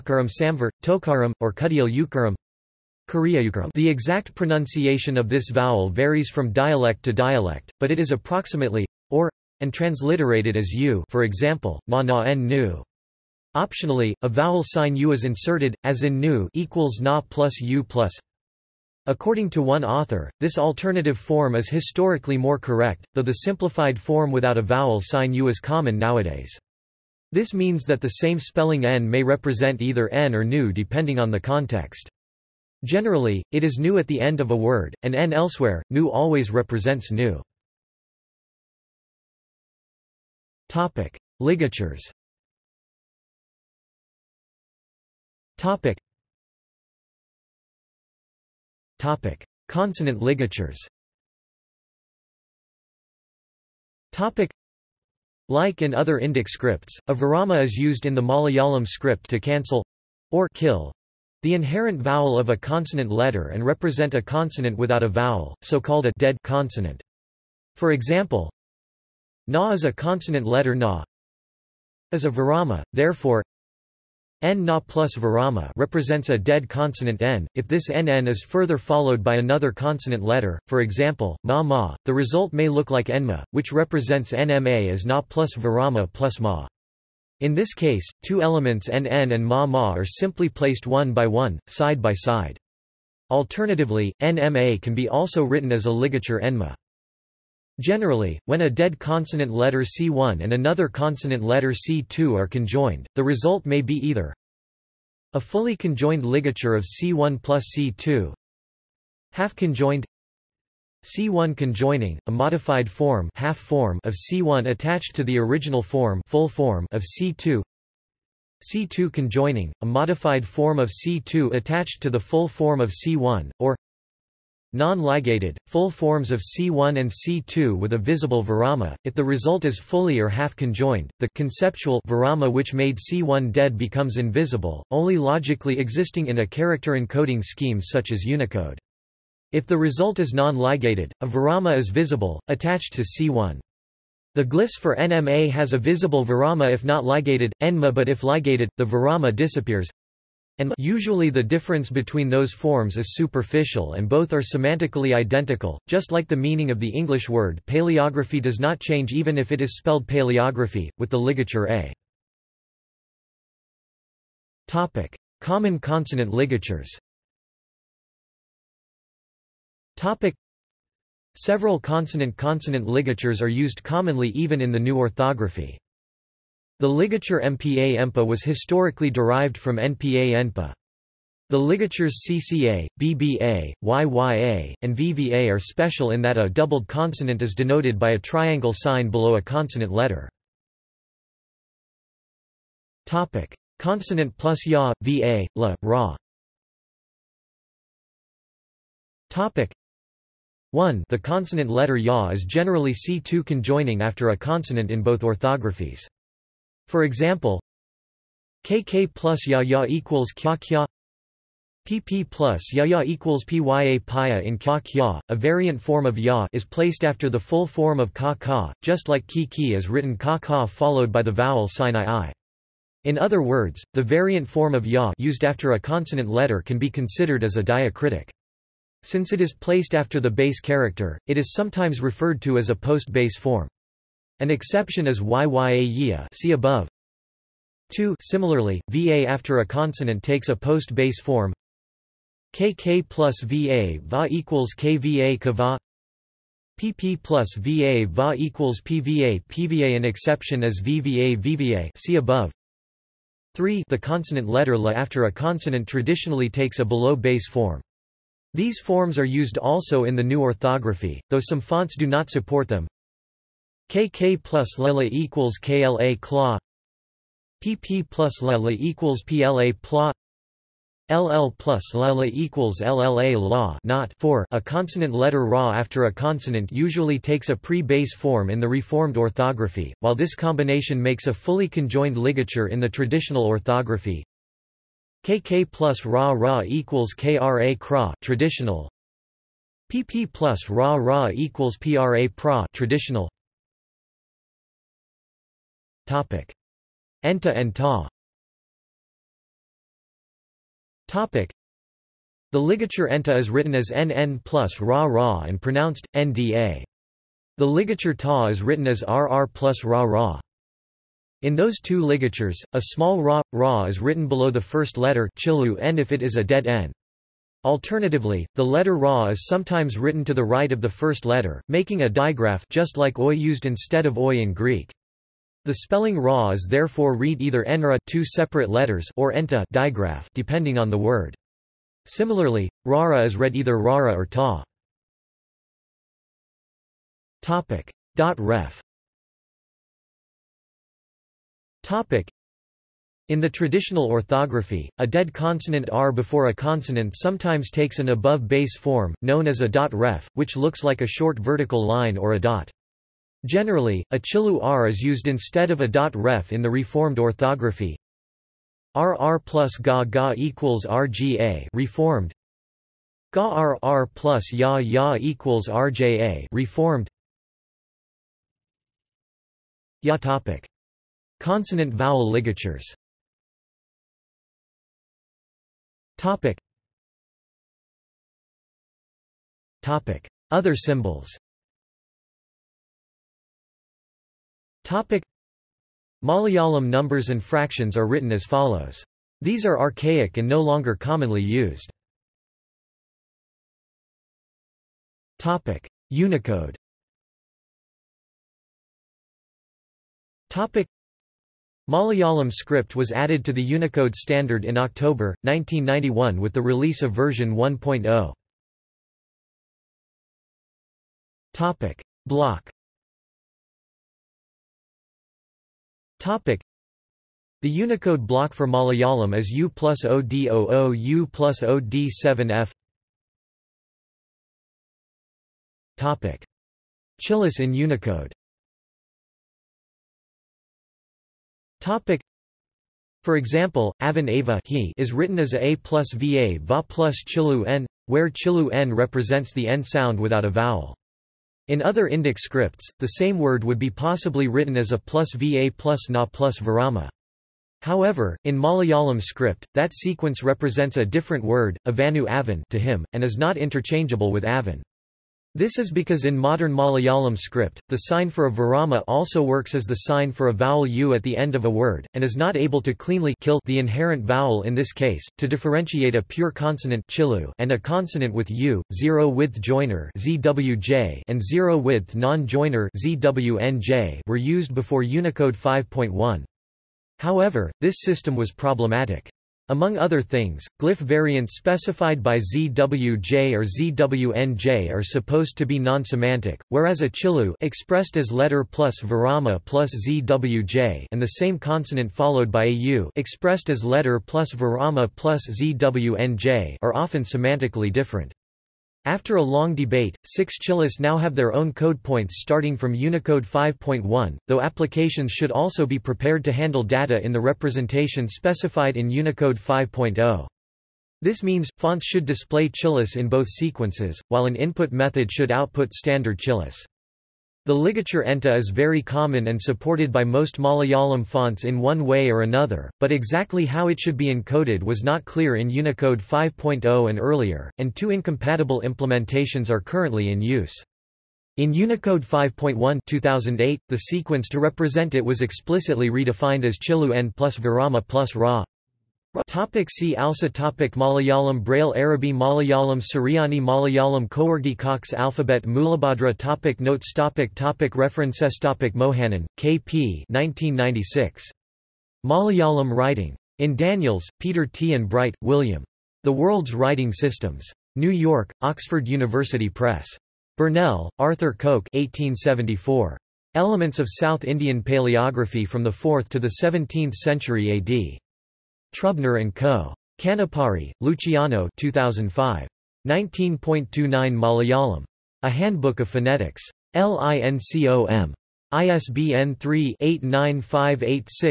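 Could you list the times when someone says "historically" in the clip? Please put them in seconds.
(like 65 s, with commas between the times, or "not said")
21 s, 178 s.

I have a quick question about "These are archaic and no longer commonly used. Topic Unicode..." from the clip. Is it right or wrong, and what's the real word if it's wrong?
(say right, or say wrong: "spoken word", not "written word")
right.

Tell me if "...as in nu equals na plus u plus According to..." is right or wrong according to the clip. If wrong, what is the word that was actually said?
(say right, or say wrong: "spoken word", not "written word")
right.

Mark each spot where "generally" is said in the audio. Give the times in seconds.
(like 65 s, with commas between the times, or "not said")
32 s, 97 s, 202 s, 353 s.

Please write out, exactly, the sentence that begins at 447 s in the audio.
However, in Malayalam script, that sequence represents a different word, avanu avan to him, and is not interchangeable with avan.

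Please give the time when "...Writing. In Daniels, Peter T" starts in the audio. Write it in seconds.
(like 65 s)
552 s.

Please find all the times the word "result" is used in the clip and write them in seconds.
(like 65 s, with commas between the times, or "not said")
82 s, 103 s, 129 s, 139 s.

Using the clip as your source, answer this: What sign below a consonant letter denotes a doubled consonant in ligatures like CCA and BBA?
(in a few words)
triangle sign.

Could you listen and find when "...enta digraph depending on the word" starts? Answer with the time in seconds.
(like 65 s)
329 s.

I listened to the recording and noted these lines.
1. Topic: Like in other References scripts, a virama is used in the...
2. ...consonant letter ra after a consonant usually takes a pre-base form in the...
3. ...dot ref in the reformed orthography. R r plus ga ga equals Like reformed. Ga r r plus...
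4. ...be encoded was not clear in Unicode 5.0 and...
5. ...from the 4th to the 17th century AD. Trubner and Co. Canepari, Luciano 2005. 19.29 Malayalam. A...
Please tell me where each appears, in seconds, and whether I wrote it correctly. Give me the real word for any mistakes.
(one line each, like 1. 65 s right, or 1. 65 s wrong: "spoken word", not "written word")
1. 54 s wrong: "Indic", not "References"
2. 274 s right
3. 355 s wrong: "RGA", not "Like"
4. 524 s right
5. 565 s right.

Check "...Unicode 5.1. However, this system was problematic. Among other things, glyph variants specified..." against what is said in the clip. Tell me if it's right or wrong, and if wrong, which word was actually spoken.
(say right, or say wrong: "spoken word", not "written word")
right.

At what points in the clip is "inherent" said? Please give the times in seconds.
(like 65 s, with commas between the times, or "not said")
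61 s, 463 s.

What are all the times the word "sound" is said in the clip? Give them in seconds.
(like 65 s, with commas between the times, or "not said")
439 s.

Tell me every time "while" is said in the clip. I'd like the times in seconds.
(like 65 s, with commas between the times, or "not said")
279 s, 514 s.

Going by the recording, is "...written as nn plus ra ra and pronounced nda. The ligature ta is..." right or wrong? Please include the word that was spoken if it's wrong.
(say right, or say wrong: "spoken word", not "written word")
right.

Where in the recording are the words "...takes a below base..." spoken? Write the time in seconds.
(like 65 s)
256 s.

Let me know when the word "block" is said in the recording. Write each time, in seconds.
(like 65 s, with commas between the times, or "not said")
412 s, 418 s.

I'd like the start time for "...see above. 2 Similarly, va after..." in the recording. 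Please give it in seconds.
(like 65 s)
236 s.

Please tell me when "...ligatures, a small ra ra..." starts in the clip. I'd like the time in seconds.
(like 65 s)
312 s.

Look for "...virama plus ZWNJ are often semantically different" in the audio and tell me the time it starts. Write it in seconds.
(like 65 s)
494 s.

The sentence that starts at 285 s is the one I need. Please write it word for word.
KK plus ra ra equals KRA kra traditional.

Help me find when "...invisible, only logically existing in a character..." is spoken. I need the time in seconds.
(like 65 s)
134 s.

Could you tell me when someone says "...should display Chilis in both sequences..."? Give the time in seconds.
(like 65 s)
512 s.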